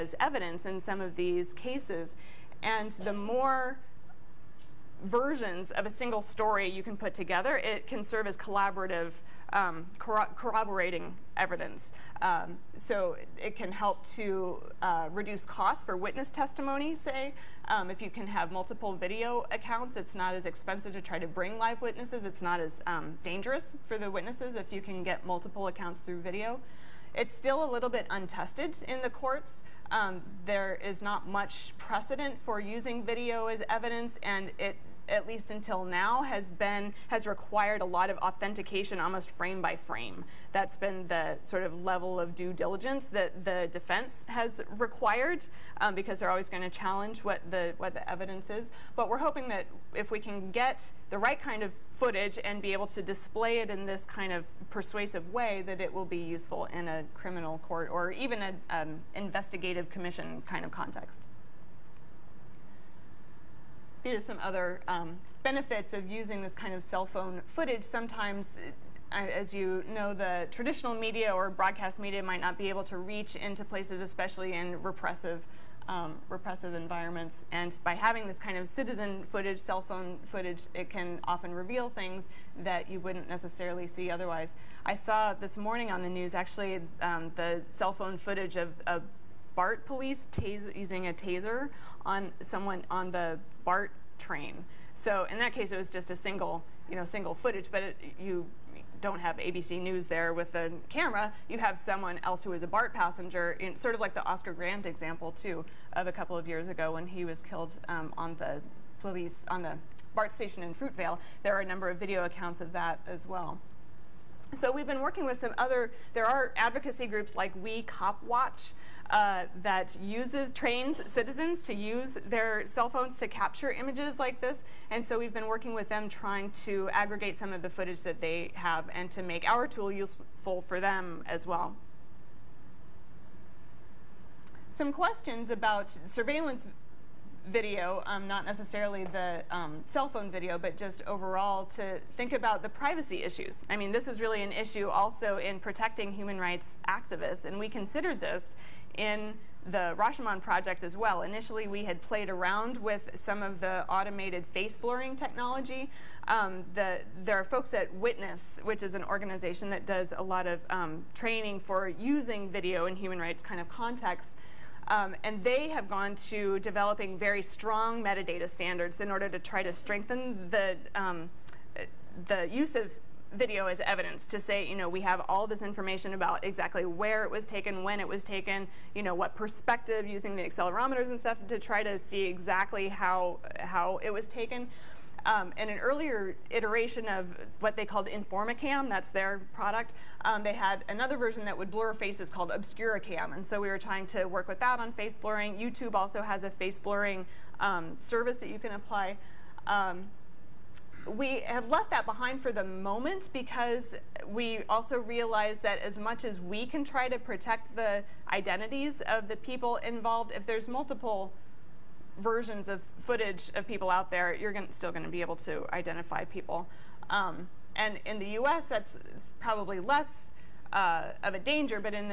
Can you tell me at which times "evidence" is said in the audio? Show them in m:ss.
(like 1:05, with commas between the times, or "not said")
0:00, 0:11, 0:33, 0:48, 2:53.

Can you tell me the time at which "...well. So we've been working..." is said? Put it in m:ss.
1:53.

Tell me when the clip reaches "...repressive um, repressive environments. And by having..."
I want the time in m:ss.
1:14.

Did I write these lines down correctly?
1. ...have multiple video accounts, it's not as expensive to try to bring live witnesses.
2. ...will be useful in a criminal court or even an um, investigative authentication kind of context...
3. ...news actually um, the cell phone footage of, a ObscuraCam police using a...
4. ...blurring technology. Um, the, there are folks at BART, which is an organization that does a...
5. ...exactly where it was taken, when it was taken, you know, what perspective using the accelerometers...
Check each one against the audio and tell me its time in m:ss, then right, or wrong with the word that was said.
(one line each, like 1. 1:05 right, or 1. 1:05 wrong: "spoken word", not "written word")
1. 0:18 right
2. 0:55 wrong: "commission", not "authentication"
3. 1:26 wrong: "BART", not "ObscuraCam"
4. 2:34 wrong: "Witness", not "BART"
5. 2:56 right.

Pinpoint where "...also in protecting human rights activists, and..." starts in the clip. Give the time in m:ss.
2:24.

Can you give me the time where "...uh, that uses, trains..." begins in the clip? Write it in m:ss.
1:59.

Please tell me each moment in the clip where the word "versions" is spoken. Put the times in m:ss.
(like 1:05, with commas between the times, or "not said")
0:05, 3:11, 3:32.